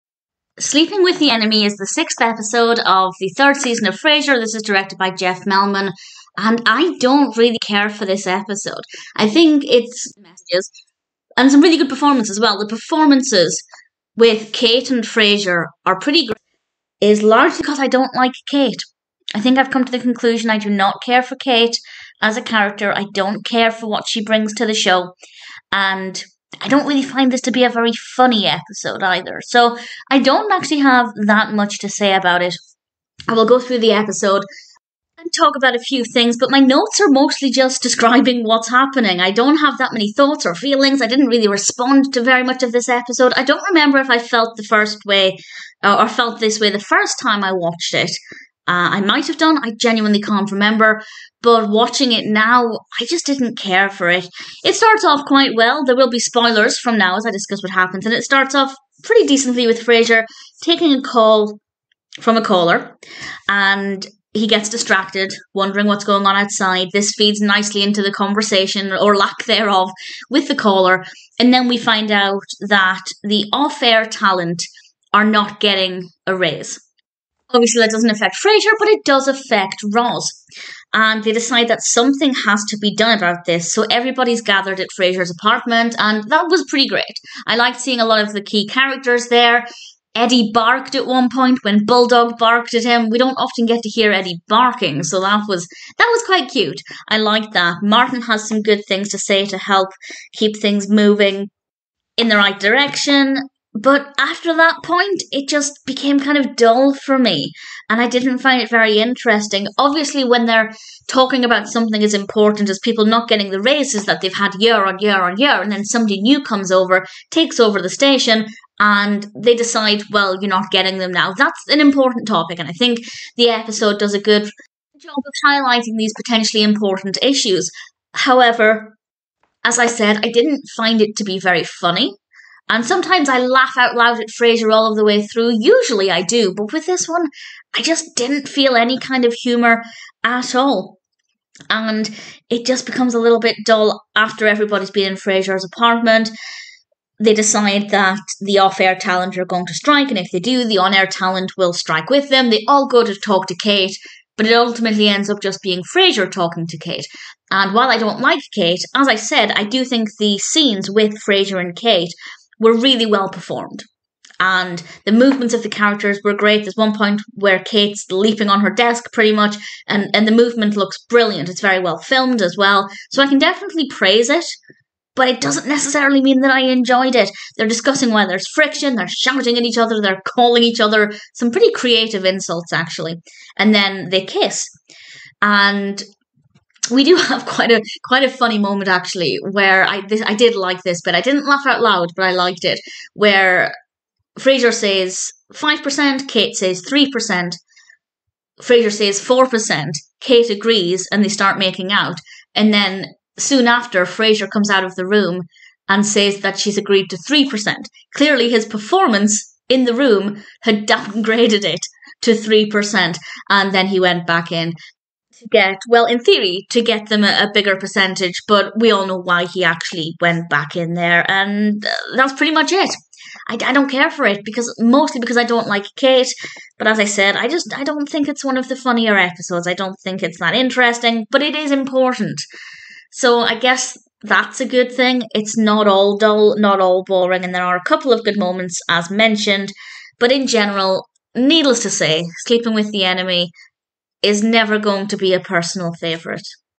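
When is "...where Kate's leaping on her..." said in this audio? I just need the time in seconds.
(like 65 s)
167 s.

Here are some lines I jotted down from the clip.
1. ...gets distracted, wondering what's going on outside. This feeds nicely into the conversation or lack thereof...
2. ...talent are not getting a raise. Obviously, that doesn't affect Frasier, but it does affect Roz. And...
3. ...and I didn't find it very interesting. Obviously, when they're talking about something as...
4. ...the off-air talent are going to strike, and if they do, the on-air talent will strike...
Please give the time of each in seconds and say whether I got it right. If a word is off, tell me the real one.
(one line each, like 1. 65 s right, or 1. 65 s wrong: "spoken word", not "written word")
1. 64 s right
2. 74 s right
3. 107 s right
4. 148 s right.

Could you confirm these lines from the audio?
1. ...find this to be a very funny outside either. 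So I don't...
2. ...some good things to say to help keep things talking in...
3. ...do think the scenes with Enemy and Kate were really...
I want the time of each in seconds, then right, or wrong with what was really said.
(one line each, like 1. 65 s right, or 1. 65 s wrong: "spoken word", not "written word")
1. 27 s wrong: "episode", not "outside"
2. 98 s wrong: "moving", not "talking"
3. 159 s wrong: "Frasier", not "Enemy".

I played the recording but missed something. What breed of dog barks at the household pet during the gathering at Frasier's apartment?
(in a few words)
Bulldog.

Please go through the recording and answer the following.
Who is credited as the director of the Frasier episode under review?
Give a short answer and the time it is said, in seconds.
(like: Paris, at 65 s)
Jeff Melman, at 5 s.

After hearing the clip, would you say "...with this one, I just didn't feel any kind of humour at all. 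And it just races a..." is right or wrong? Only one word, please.
wrong.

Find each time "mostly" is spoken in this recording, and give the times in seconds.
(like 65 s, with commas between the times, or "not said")
37 s, 224 s.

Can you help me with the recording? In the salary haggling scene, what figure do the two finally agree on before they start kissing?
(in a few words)
4%.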